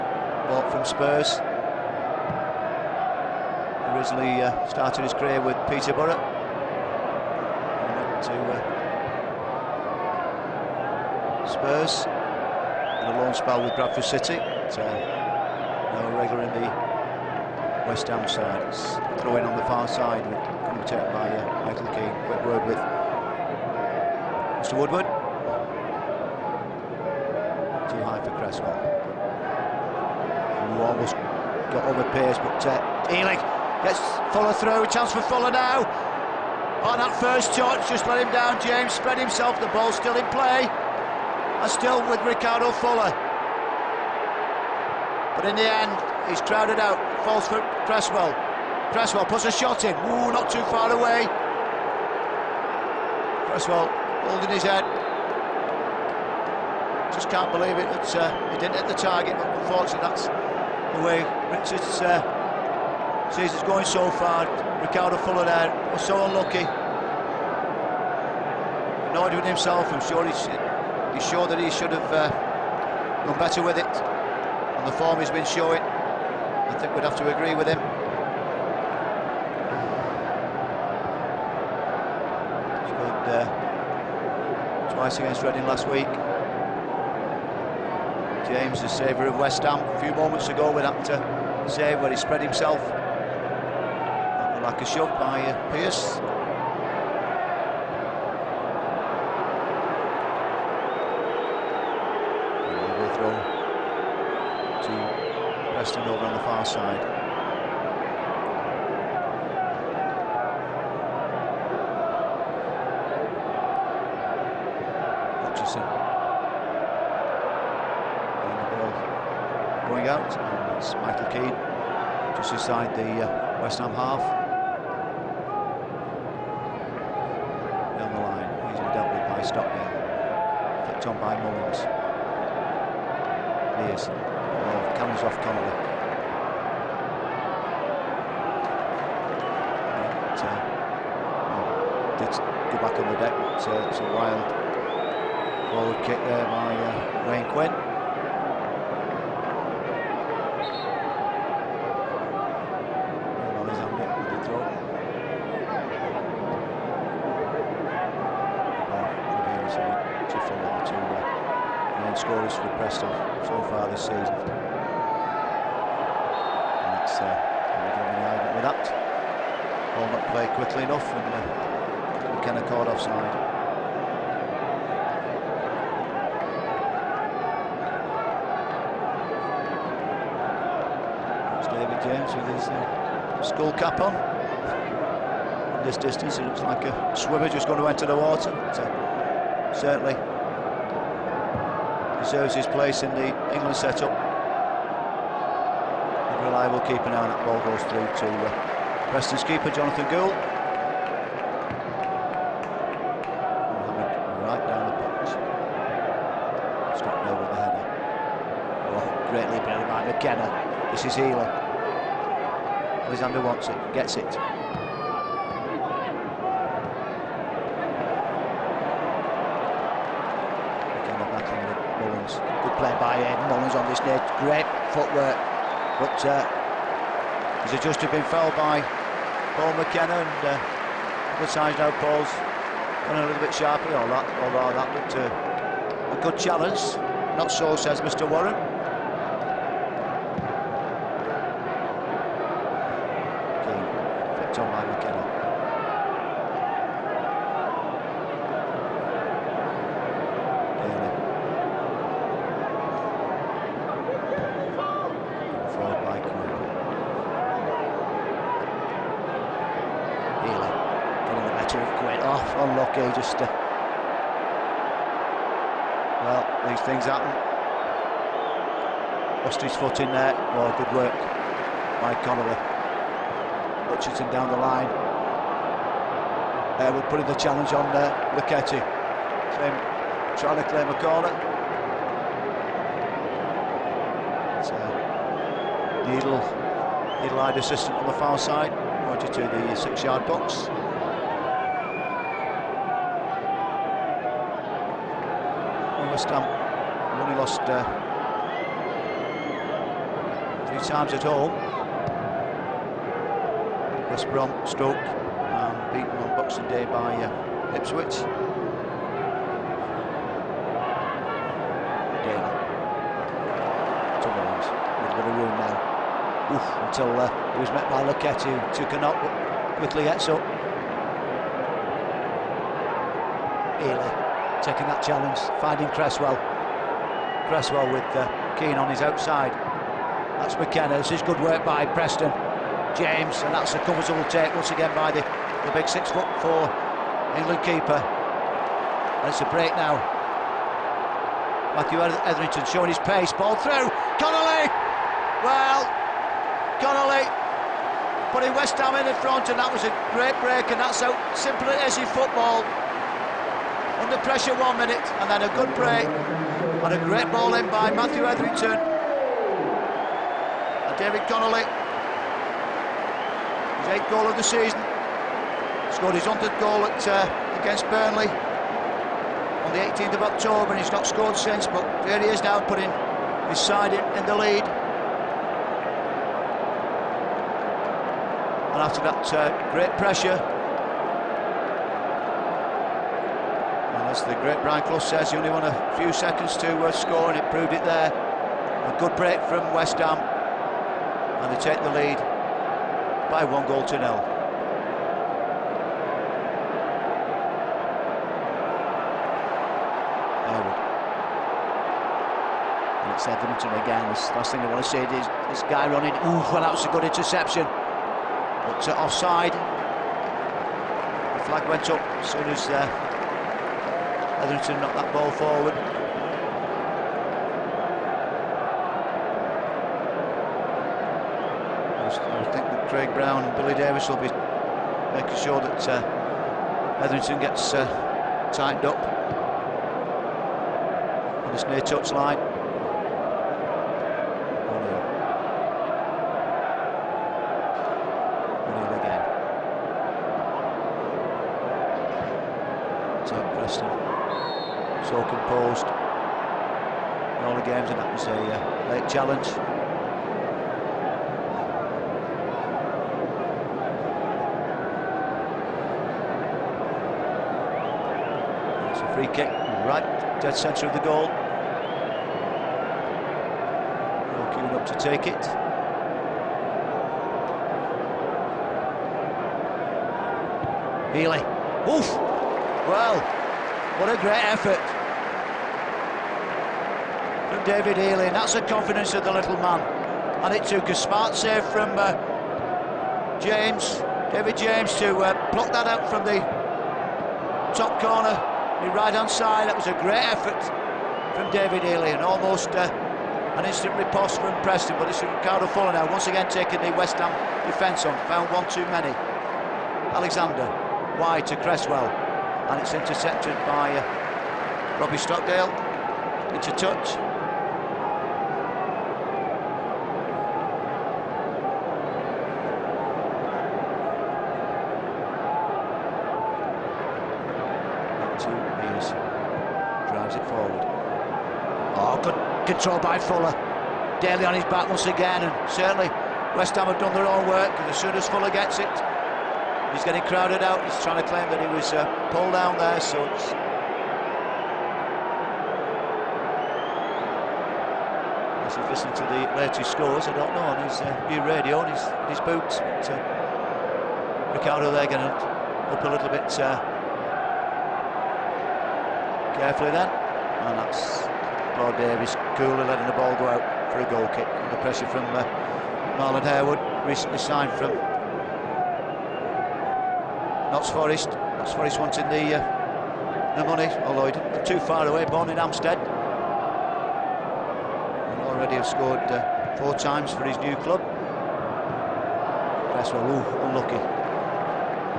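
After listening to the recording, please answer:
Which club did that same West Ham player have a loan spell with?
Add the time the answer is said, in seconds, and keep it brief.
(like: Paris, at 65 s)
Bradford City, at 13 s.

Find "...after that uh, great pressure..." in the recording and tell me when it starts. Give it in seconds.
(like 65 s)
378 s.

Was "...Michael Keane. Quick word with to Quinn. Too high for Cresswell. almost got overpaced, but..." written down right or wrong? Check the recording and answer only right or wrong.
wrong.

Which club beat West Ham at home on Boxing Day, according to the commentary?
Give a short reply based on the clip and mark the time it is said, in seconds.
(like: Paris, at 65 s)
Ipswich, at 307 s.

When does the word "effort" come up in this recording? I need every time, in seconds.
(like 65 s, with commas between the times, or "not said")
474 s, 490 s.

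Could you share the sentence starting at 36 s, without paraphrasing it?
On that first touch, just let him down, James.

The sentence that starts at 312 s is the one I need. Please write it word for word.
Again, Tummins a bit of room now.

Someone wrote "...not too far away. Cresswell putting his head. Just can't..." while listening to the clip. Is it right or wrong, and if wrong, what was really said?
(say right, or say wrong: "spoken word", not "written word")
wrong: "holding", not "putting".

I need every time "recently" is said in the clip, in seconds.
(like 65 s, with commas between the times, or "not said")
557 s.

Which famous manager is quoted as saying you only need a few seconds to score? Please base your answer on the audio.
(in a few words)
Brian Clough.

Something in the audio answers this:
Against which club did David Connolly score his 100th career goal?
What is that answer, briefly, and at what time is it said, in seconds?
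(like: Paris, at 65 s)
Burnley, at 367 s.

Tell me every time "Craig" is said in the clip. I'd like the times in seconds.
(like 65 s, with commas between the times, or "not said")
422 s.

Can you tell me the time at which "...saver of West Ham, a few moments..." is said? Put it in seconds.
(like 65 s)
88 s.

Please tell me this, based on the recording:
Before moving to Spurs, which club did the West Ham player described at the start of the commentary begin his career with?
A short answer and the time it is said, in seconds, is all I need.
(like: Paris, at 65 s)
Peterborough, at 5 s.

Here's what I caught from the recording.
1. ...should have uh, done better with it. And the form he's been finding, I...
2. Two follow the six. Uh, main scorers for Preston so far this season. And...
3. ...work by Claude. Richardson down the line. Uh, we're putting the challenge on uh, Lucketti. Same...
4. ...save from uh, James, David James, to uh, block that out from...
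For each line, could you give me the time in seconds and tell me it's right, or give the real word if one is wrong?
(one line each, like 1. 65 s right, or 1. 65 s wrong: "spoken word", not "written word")
1. 71 s wrong: "showing", not "finding"
2. 160 s wrong: "two", not "six"
3. 270 s wrong: "Connolly", not "Claude"
4. 481 s right.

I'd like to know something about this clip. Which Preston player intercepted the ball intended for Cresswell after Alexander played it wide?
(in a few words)
Robbie Stockdale.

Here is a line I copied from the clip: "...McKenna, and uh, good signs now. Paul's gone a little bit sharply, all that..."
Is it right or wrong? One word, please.
right.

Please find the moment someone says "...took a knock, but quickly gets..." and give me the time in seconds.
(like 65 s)
318 s.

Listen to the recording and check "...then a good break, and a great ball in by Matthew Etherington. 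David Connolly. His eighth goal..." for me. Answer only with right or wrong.
right.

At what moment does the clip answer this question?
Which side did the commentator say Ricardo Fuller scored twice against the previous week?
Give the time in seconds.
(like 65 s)
85 s.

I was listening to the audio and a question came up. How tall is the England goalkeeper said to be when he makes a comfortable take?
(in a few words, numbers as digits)
6 foot 4.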